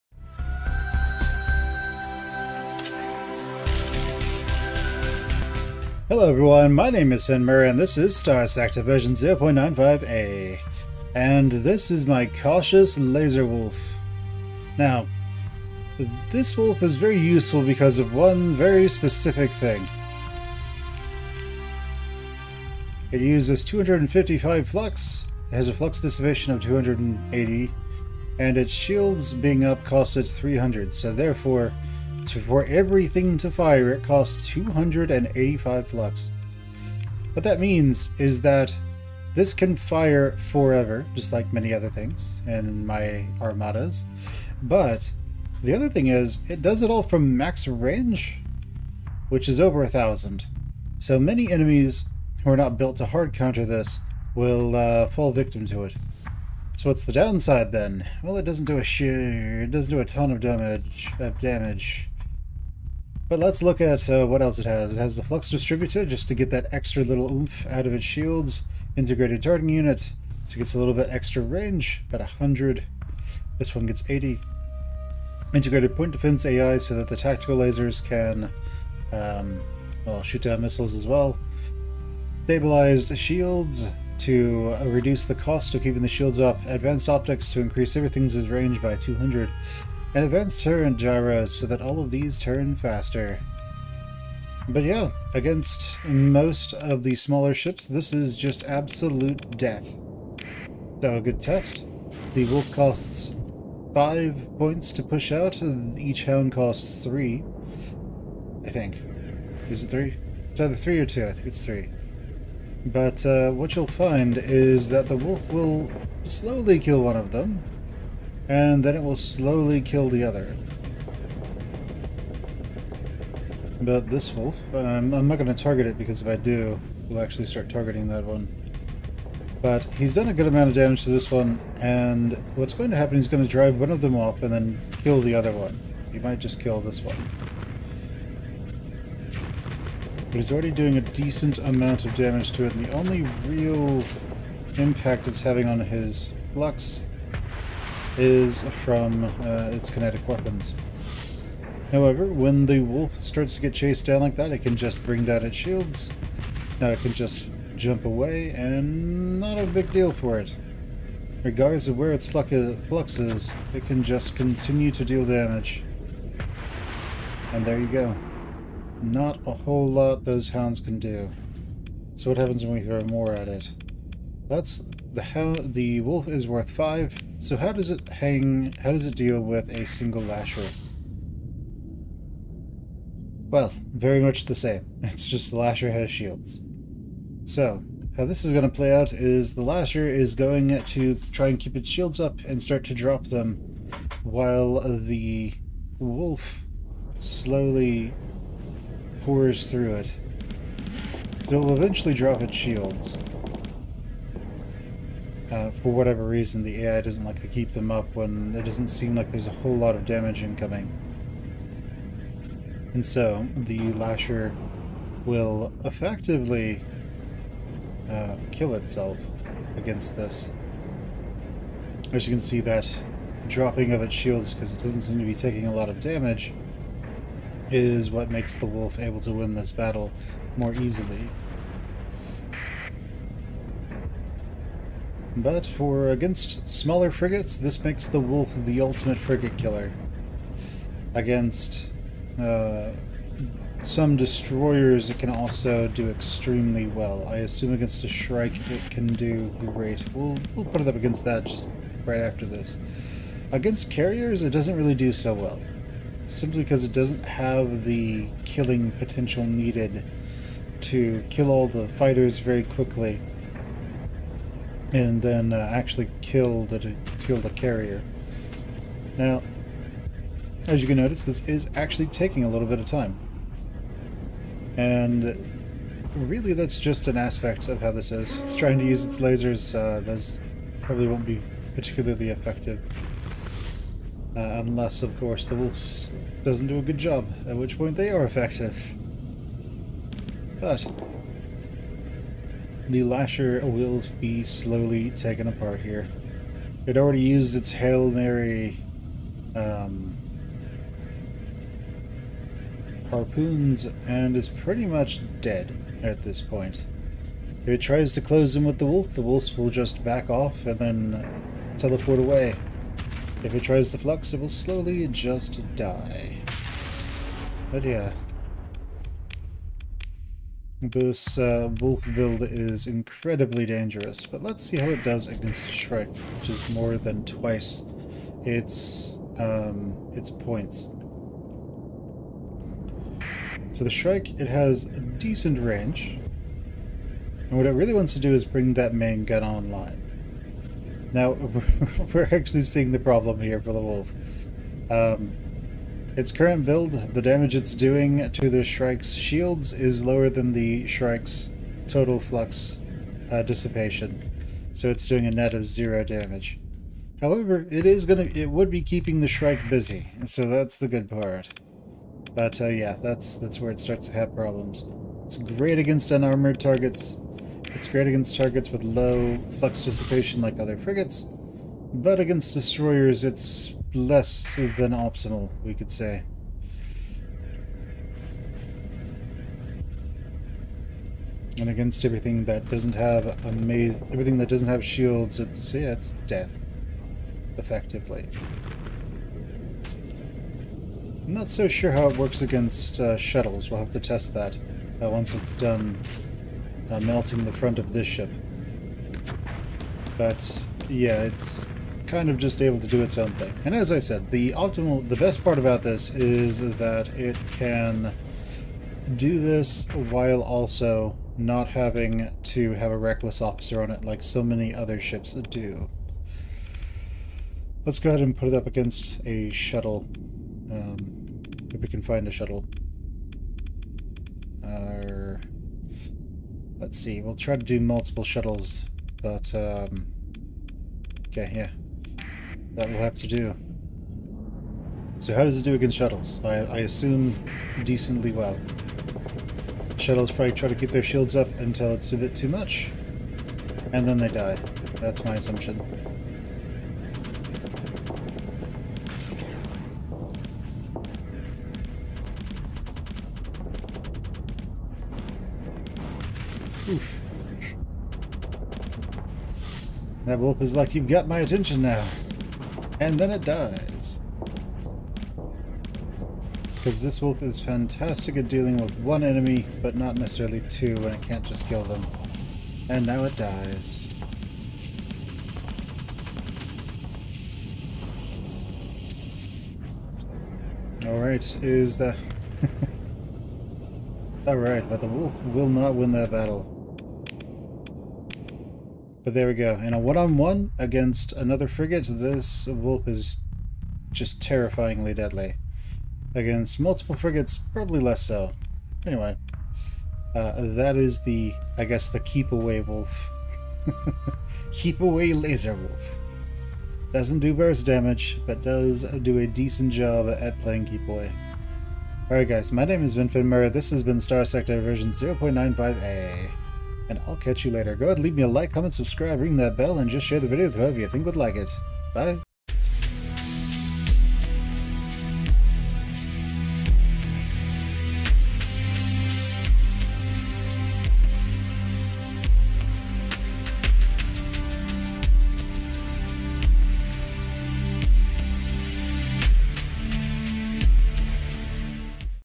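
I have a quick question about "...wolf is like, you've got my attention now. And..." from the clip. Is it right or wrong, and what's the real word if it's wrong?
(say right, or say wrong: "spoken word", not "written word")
right.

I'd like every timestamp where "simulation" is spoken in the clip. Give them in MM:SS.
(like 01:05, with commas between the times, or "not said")
not said.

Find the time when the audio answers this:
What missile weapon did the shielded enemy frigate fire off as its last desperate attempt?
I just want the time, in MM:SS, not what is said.
05:03.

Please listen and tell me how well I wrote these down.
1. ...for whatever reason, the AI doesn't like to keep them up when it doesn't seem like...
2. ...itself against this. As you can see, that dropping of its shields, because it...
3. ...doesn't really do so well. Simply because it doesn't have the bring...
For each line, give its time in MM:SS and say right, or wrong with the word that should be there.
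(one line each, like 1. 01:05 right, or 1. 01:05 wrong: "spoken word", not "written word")
1. 03:25 right
2. 03:38 right
3. 04:14 wrong: "killing", not "bring".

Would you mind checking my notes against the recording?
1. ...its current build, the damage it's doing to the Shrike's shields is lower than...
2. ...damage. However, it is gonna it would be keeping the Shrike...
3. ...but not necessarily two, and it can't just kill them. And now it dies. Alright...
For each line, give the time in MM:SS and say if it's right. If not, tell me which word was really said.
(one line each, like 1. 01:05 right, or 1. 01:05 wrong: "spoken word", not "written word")
1. 05:46 right
2. 05:56 right
3. 07:49 right.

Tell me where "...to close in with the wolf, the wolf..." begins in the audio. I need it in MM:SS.
05:08.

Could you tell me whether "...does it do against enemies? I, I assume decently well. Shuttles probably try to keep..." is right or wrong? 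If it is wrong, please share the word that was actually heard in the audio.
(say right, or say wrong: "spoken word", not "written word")
wrong: "shuttles", not "enemies".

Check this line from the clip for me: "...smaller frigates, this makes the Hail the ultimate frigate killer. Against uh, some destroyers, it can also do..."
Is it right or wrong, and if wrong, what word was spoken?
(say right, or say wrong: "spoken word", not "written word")
wrong: "Wolf", not "Hail".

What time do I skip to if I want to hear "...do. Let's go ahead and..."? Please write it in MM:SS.
06:55.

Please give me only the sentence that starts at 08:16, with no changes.
Against multiple frigates, probably less so.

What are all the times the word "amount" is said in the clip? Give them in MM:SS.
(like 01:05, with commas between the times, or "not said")
02:10, 02:21.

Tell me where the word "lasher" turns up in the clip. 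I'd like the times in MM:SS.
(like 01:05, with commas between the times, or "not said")
03:00, 03:05, 03:09, 03:33, 04:53.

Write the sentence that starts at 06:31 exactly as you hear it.
I'm not so sure how it works against uh, shuttles.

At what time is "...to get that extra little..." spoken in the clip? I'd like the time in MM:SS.
01:06.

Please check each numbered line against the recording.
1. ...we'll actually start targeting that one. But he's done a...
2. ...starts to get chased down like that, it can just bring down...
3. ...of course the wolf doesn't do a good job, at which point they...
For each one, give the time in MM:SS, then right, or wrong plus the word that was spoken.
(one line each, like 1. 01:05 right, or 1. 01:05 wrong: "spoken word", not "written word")
1. 02:07 right
2. 02:33 right
3. 04:45 right.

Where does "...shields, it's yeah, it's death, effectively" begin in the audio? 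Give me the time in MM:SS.
06:24.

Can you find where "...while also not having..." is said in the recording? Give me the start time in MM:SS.
06:49.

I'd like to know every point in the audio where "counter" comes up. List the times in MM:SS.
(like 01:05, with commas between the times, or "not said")
00:53.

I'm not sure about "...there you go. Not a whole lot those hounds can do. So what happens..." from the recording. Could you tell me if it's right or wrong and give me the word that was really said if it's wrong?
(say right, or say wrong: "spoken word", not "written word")
right.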